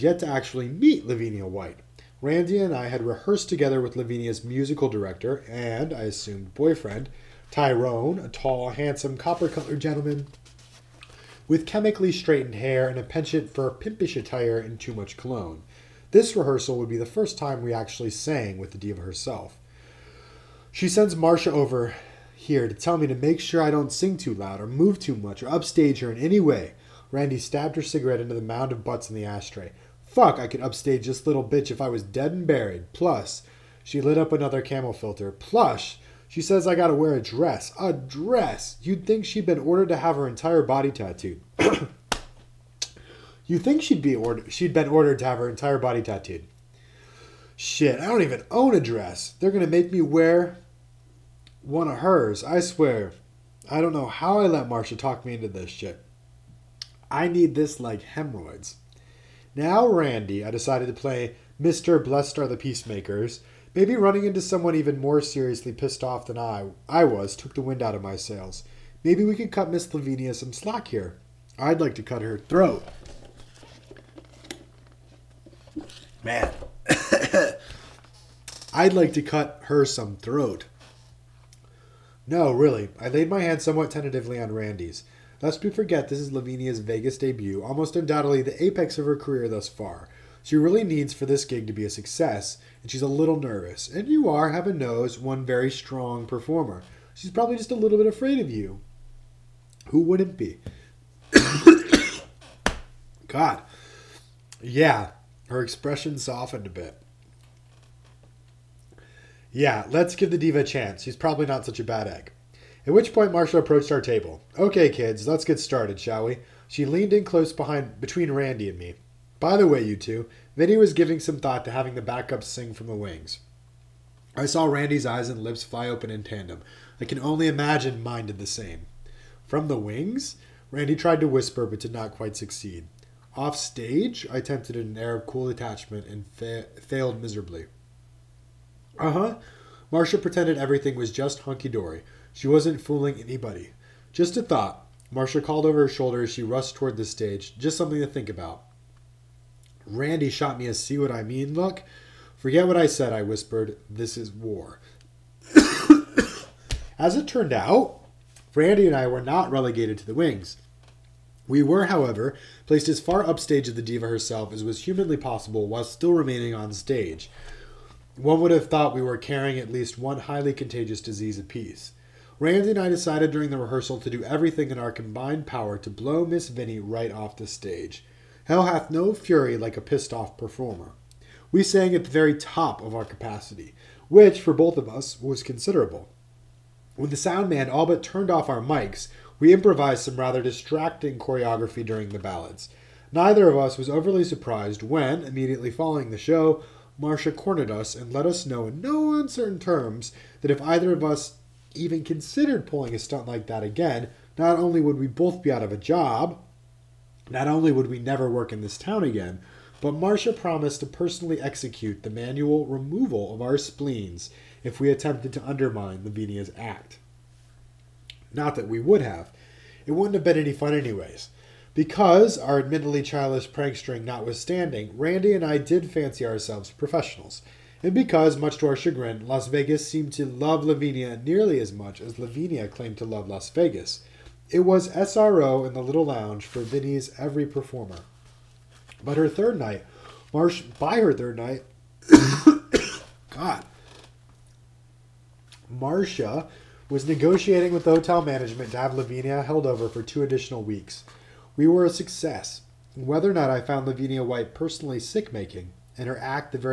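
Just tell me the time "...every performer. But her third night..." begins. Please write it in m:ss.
3:57.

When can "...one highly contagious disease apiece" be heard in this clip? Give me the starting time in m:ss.
2:49.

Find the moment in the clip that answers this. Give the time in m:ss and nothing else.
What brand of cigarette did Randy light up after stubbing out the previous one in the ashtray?
0:34.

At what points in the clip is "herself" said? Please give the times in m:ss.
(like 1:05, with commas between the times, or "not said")
0:19, 2:44.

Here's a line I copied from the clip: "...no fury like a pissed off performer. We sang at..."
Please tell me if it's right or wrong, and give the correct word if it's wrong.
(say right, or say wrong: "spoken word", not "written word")
right.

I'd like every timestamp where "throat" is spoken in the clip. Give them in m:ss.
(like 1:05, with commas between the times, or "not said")
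1:12, 1:20.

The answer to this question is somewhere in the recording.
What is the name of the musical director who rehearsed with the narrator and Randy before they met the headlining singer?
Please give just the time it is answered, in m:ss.
0:07.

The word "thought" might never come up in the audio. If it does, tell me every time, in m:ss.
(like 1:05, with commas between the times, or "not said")
2:01, 2:24, 2:48.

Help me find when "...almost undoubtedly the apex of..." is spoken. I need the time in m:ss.
1:27.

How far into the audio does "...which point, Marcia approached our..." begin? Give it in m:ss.
1:52.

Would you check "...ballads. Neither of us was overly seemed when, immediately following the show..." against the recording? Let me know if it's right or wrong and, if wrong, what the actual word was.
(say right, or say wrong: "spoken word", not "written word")
wrong: "surprised", not "seemed".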